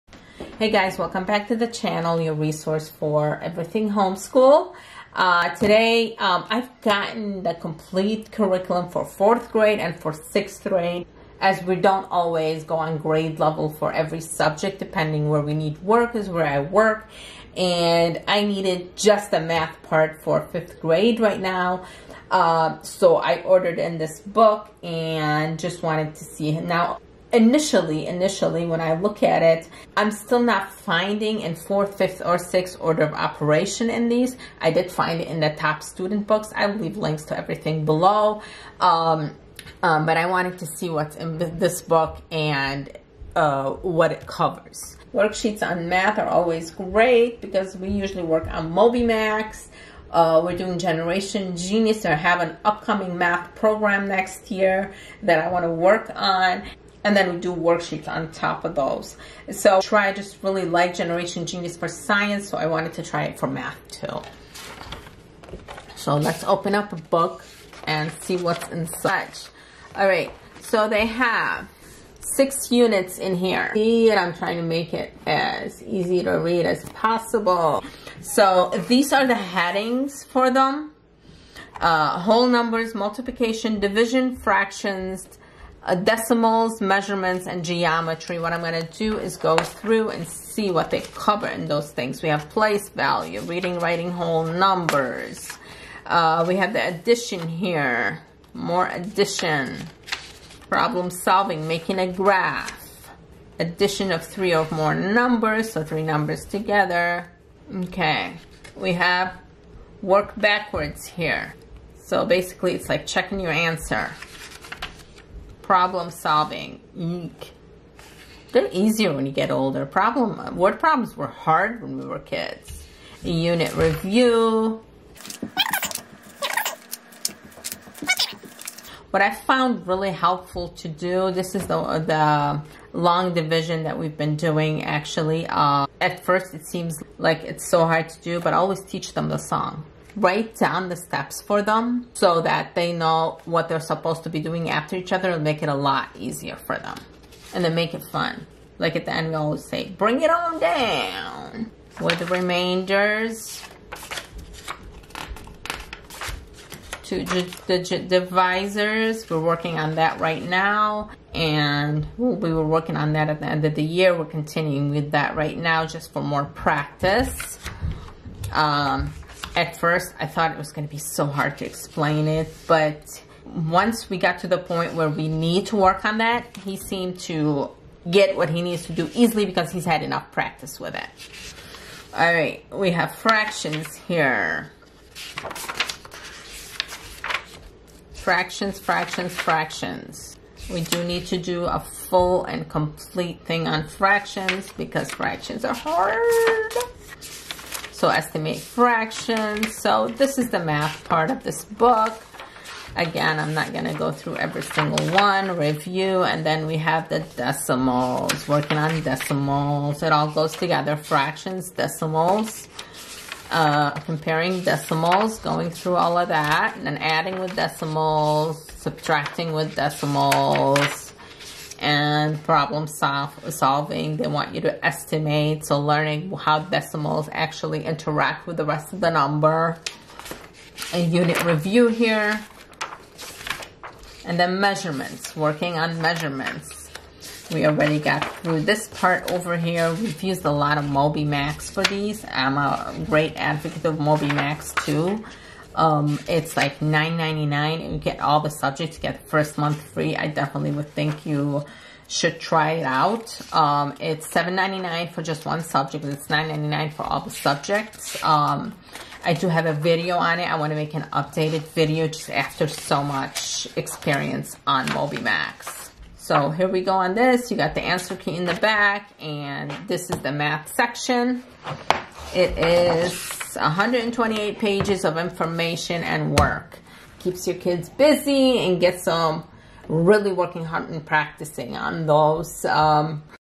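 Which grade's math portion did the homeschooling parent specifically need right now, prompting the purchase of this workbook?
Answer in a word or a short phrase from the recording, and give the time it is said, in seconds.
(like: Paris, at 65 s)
Fifth grade, at 20 s.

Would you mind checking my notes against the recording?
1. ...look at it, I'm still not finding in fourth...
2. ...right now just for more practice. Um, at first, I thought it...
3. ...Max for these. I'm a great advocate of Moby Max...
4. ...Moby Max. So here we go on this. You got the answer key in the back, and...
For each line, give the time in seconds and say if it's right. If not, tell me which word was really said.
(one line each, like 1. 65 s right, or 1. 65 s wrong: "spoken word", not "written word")
1. 28 s right
2. 165 s right
3. 241 s right
4. 264 s right.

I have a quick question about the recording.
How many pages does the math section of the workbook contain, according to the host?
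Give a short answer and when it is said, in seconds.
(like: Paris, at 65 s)
128, at 273 s.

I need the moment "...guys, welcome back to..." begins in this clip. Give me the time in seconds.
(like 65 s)
0 s.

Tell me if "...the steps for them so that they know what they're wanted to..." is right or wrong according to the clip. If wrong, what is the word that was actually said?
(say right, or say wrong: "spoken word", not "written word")
wrong: "supposed", not "wanted".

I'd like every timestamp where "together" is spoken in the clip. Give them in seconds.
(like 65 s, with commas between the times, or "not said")
106 s, 210 s.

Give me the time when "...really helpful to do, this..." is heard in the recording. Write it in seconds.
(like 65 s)
129 s.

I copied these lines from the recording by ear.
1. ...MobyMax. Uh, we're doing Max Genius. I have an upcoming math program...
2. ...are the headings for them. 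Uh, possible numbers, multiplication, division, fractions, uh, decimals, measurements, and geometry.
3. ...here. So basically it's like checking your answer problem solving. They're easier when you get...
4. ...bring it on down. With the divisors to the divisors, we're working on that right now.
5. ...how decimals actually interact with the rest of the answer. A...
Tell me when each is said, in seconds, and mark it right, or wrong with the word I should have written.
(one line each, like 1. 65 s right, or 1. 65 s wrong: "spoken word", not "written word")
1. 48 s wrong: "Generation", not "Max"
2. 79 s wrong: "whole", not "possible"
3. 111 s right
4. 149 s wrong: "remainders", not "divisors"
5. 226 s wrong: "number", not "answer".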